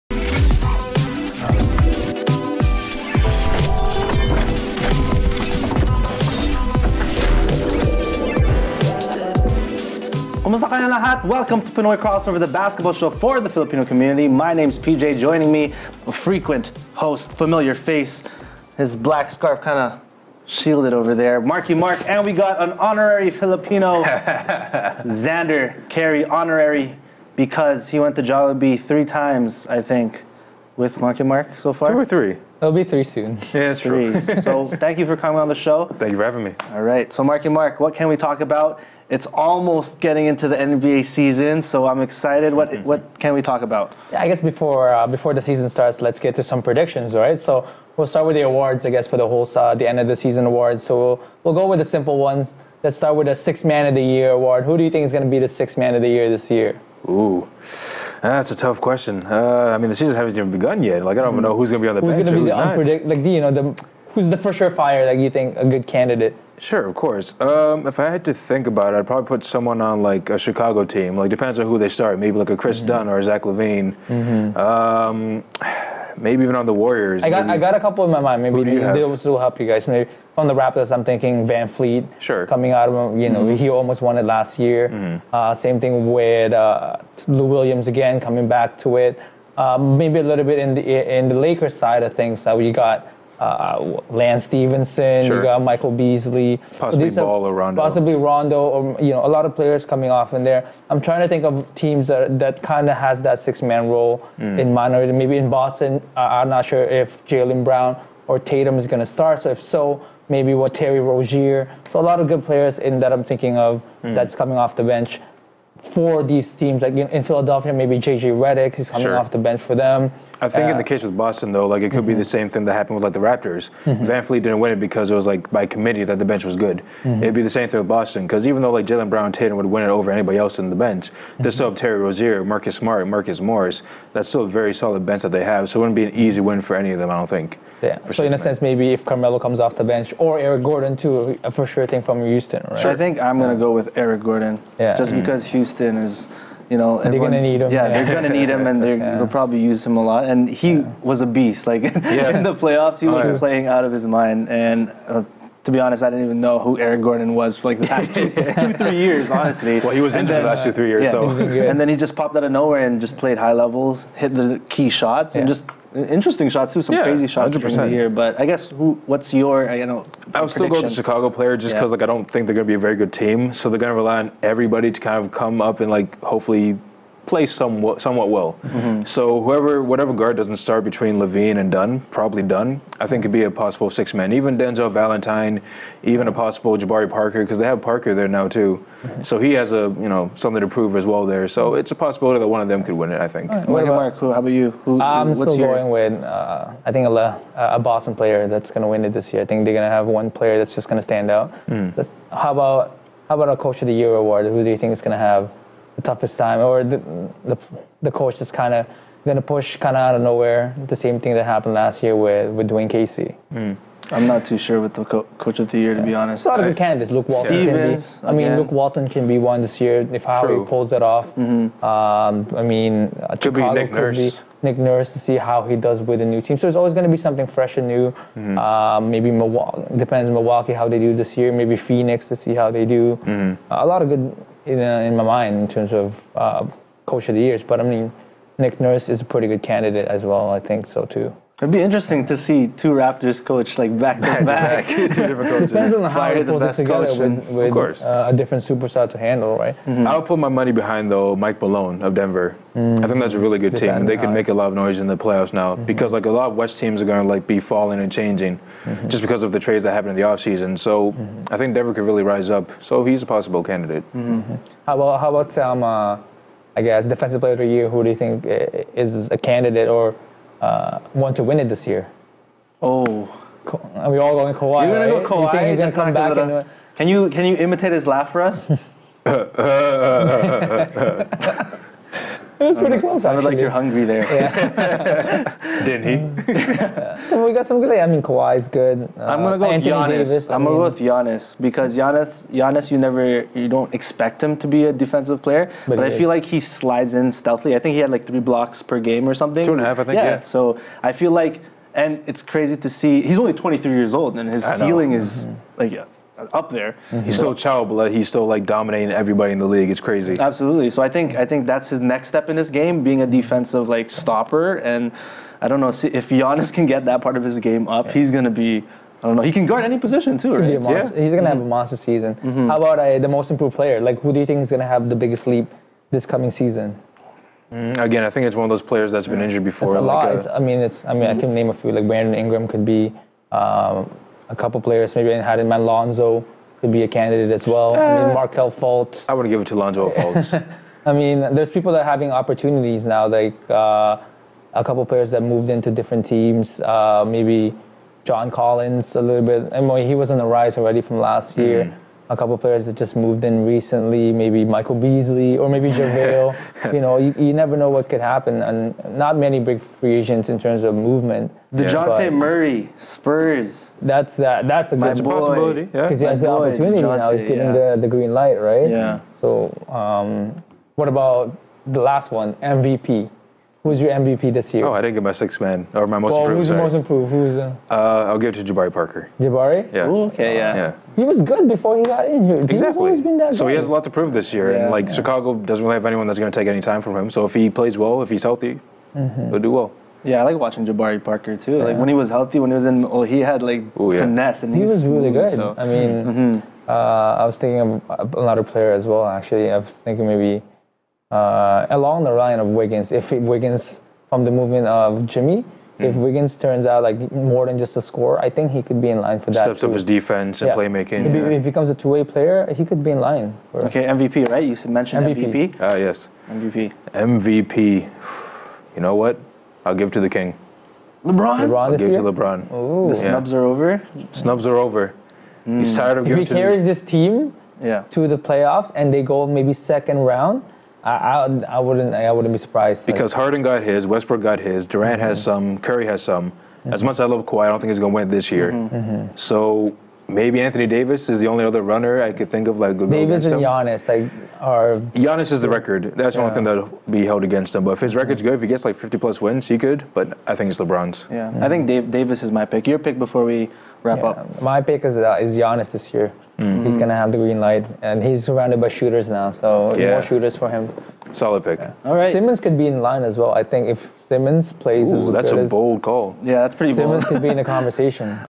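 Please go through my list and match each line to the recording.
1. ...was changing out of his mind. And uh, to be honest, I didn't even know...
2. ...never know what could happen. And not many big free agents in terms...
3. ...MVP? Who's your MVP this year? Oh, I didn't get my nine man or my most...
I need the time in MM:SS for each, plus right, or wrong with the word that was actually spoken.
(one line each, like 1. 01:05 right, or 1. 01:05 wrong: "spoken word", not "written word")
1. 02:33 wrong: "playing", not "changing"
2. 05:57 right
3. 06:12 wrong: "six", not "nine".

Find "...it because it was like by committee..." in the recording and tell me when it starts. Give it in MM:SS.
02:04.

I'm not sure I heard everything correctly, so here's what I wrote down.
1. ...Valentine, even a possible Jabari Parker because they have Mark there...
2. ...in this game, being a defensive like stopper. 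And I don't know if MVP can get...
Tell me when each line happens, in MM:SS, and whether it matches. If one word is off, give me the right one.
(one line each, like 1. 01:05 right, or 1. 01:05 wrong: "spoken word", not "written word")
1. 03:04 wrong: "Parker", not "Mark"
2. 05:12 wrong: "Giannis", not "MVP".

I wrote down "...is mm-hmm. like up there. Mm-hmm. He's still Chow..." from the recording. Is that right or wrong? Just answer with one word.
right.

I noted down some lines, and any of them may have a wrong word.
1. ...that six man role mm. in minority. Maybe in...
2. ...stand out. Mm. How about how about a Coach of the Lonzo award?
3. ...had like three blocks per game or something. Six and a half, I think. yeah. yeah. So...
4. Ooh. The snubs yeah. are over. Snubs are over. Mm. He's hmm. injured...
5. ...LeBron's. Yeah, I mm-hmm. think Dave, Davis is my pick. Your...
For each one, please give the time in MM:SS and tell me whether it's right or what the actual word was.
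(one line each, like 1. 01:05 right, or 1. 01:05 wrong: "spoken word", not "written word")
1. 01:43 right
2. 03:21 wrong: "Year", not "Lonzo"
3. 04:57 wrong: "Two", not "Six"
4. 07:02 wrong: "tired", not "injured"
5. 07:30 right.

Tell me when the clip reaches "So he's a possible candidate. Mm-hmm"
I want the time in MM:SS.
04:22.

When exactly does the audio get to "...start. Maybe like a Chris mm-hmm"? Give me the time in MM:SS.
01:11.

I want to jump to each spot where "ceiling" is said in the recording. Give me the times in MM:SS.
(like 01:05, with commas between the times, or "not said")
05:04.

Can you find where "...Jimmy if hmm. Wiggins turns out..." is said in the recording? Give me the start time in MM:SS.
06:45.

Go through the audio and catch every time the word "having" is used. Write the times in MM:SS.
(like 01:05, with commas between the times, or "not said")
00:36, 05:42.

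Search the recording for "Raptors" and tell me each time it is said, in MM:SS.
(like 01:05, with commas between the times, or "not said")
01:20, 02:03, 04:02.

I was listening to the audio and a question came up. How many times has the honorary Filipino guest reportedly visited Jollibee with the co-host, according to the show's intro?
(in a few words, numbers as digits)
3.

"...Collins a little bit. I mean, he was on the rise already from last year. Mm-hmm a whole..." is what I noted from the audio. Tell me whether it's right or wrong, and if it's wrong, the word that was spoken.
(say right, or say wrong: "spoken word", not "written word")
wrong: "couple", not "whole".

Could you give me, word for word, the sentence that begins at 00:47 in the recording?
So we'll start with the awards, I guess, for the whole uh, the end of the season awards.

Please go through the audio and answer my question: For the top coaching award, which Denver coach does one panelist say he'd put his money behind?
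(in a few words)
Mike Malone.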